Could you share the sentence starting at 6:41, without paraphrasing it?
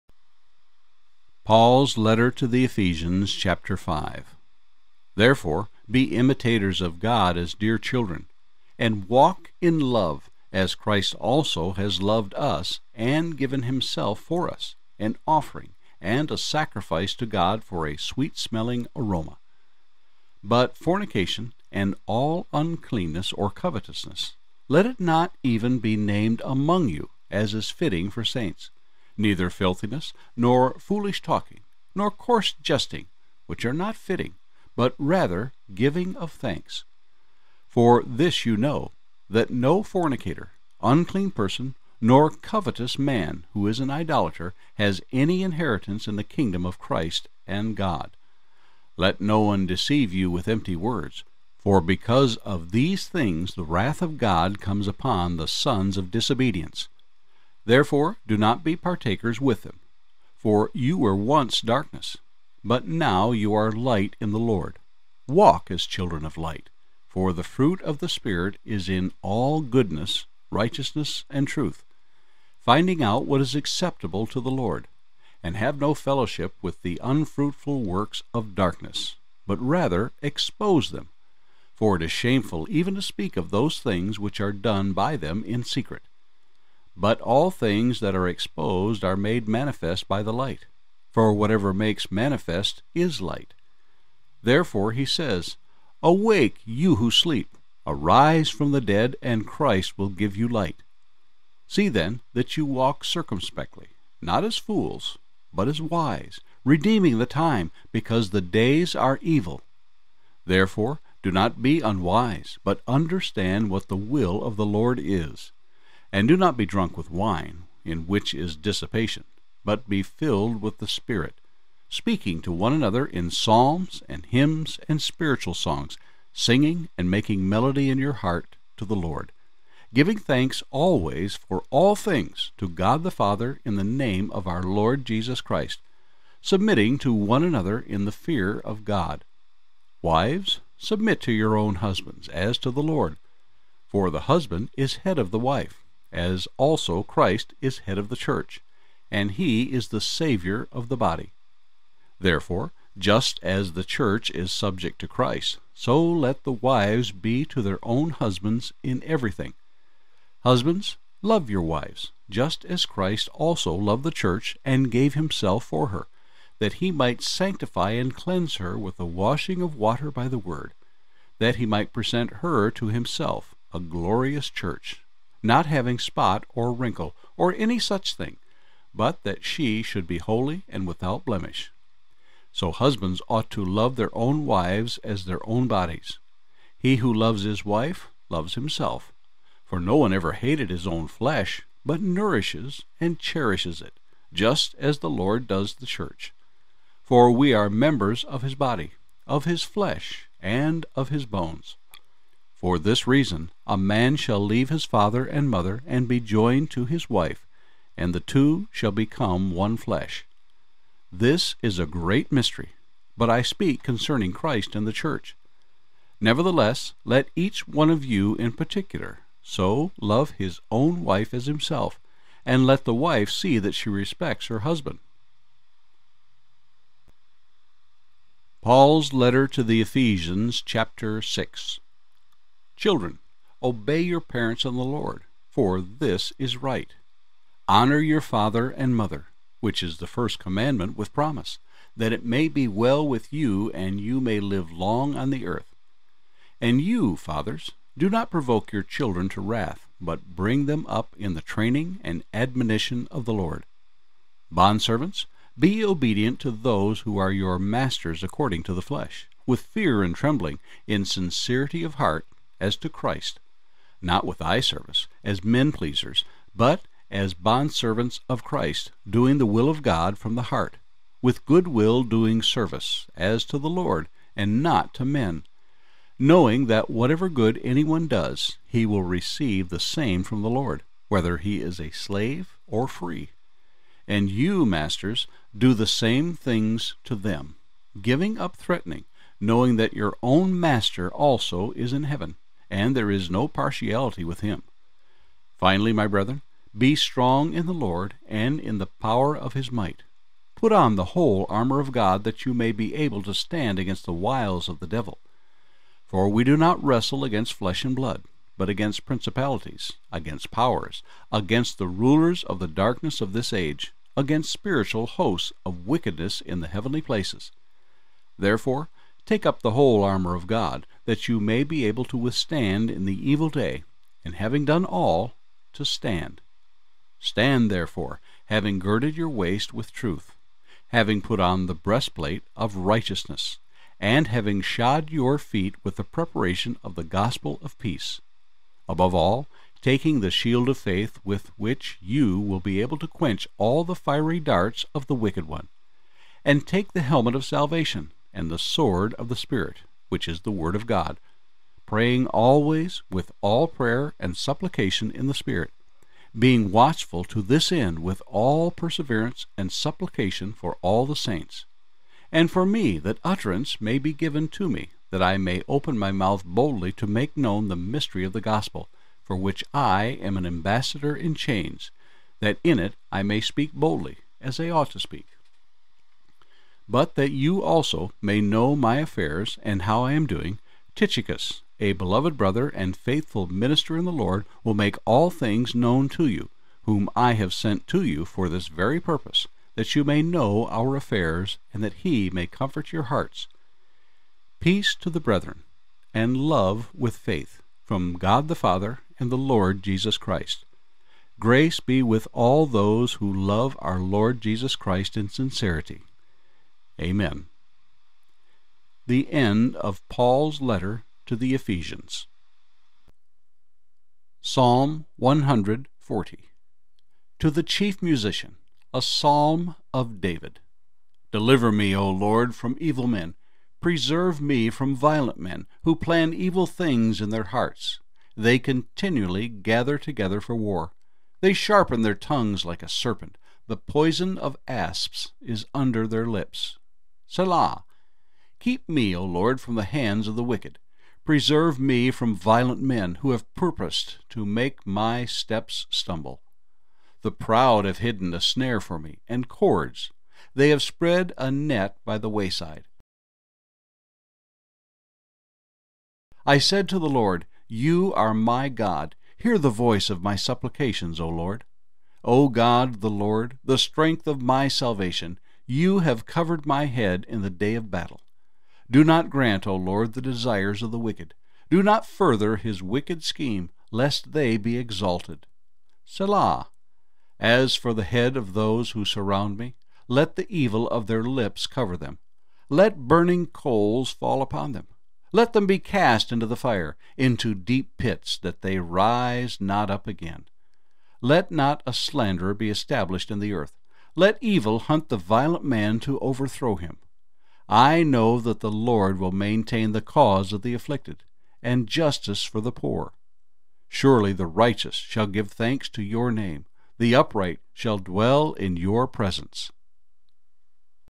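Grace be with all those who love our Lord Jesus Christ in sincerity.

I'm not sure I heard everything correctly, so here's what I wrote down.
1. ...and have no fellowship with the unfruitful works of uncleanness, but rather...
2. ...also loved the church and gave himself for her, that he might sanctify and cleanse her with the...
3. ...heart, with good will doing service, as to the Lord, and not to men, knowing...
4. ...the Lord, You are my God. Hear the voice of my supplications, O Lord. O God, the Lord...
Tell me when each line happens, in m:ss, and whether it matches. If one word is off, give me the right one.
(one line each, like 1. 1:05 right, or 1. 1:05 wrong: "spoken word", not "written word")
1. 1:15 wrong: "darkness", not "uncleanness"
2. 2:43 right
3. 4:30 right
4. 7:36 right.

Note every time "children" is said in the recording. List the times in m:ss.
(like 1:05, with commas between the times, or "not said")
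0:07, 1:05, 3:52, 4:08.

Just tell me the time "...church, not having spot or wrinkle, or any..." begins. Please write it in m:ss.
2:54.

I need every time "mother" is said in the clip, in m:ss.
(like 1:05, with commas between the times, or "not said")
3:25, 3:58.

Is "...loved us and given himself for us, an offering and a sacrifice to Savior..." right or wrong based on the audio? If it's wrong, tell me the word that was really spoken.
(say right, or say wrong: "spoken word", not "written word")
wrong: "God", not "Savior".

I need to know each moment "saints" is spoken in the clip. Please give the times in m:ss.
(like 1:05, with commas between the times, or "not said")
0:28, 6:01.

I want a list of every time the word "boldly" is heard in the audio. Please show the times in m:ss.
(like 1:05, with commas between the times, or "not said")
6:06, 6:13.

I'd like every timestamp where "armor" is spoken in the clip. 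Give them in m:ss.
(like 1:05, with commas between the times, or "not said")
5:01, 5:20.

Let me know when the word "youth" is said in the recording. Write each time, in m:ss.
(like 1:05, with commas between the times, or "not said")
not said.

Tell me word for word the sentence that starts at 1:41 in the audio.
See then that you walk circumspectly, not as fools, but as wise, redeeming the time, because the days are evil.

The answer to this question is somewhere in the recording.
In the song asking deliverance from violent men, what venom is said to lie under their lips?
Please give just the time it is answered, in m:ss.
7:13.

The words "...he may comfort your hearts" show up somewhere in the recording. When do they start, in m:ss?
6:32.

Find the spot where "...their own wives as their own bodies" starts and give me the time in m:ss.
3:03.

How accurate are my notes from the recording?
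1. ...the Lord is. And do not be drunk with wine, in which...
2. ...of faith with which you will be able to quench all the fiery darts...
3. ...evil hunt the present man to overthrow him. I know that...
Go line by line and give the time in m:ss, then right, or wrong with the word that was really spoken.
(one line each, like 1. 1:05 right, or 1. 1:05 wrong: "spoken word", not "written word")
1. 1:54 right
2. 5:40 right
3. 8:14 wrong: "violent", not "present".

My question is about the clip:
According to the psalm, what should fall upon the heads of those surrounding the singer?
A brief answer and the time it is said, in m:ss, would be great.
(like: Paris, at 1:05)
burning coals, at 8:03.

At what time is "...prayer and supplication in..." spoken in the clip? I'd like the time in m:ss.
5:53.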